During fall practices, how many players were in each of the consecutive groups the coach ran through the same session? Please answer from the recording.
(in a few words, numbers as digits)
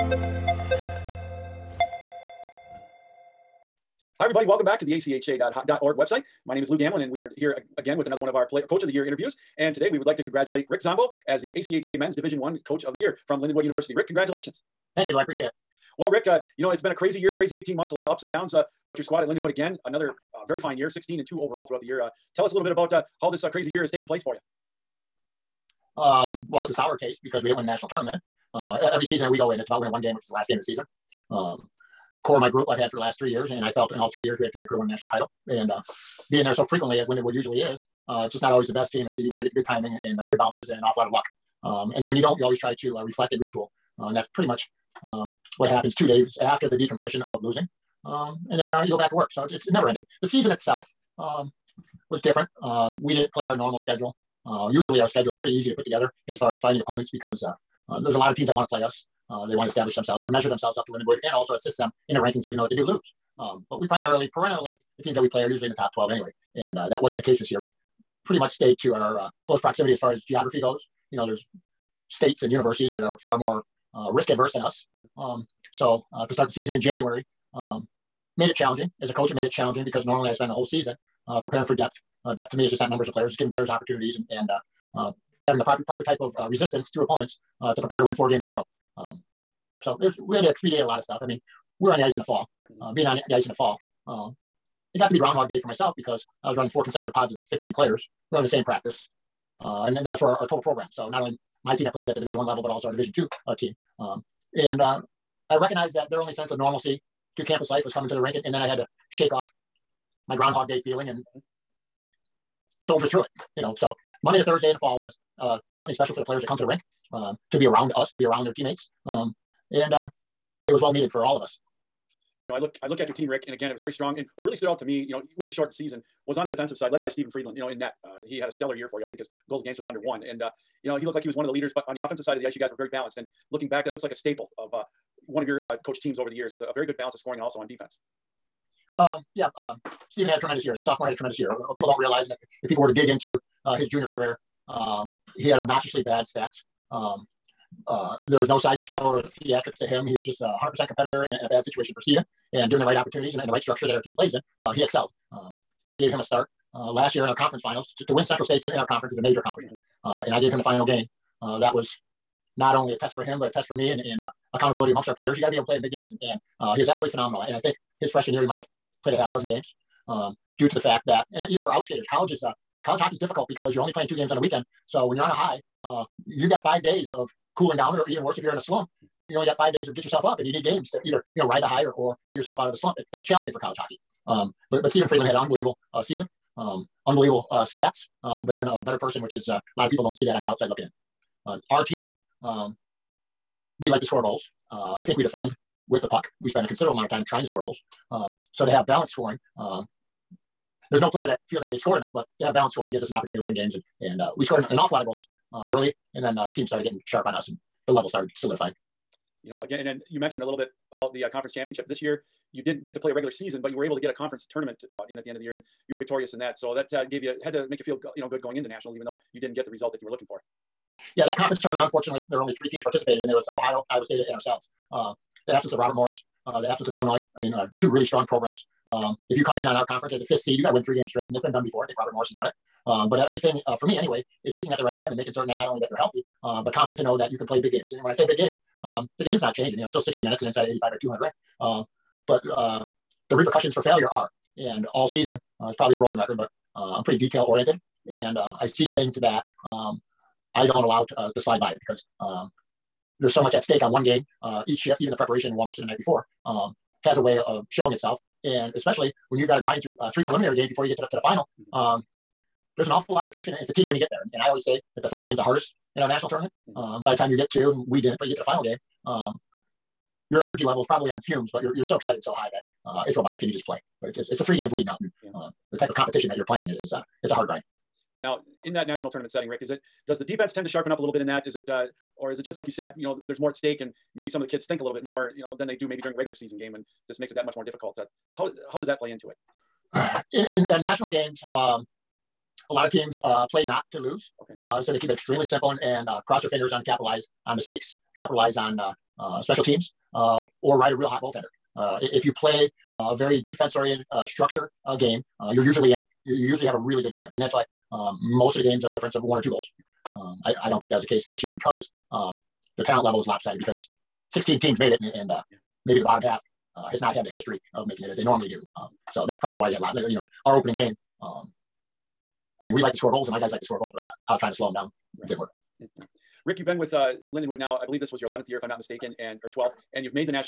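15.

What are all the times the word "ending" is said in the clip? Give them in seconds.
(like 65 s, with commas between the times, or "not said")
49 s.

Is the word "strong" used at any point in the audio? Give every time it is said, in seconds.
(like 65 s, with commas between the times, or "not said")
123 s, 228 s.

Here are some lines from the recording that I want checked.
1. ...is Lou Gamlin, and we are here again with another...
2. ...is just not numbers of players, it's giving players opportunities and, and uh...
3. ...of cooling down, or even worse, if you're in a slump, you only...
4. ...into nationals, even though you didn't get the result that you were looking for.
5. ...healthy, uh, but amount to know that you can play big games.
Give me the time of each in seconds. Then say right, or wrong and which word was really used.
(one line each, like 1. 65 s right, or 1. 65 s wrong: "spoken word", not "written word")
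1. 6 s right
2. 82 s right
3. 177 s right
4. 218 s right
5. 235 s wrong: "confident", not "amount".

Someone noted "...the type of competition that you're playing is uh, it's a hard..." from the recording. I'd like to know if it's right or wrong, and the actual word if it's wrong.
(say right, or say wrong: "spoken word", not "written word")
right.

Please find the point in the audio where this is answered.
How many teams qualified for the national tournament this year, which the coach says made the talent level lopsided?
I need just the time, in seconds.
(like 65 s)
314 s.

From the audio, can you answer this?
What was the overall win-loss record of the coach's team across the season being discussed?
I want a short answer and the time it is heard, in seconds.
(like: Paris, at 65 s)
16-2, at 20 s.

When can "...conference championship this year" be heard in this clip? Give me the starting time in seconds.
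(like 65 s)
211 s.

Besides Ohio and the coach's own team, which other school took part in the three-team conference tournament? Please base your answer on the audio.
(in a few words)
Iowa State.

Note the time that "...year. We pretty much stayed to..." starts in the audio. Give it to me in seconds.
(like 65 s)
67 s.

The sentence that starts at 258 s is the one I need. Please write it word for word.
And especially when you've got to grind through uh, three preliminary games before you get to the, to the final, mm-hmm.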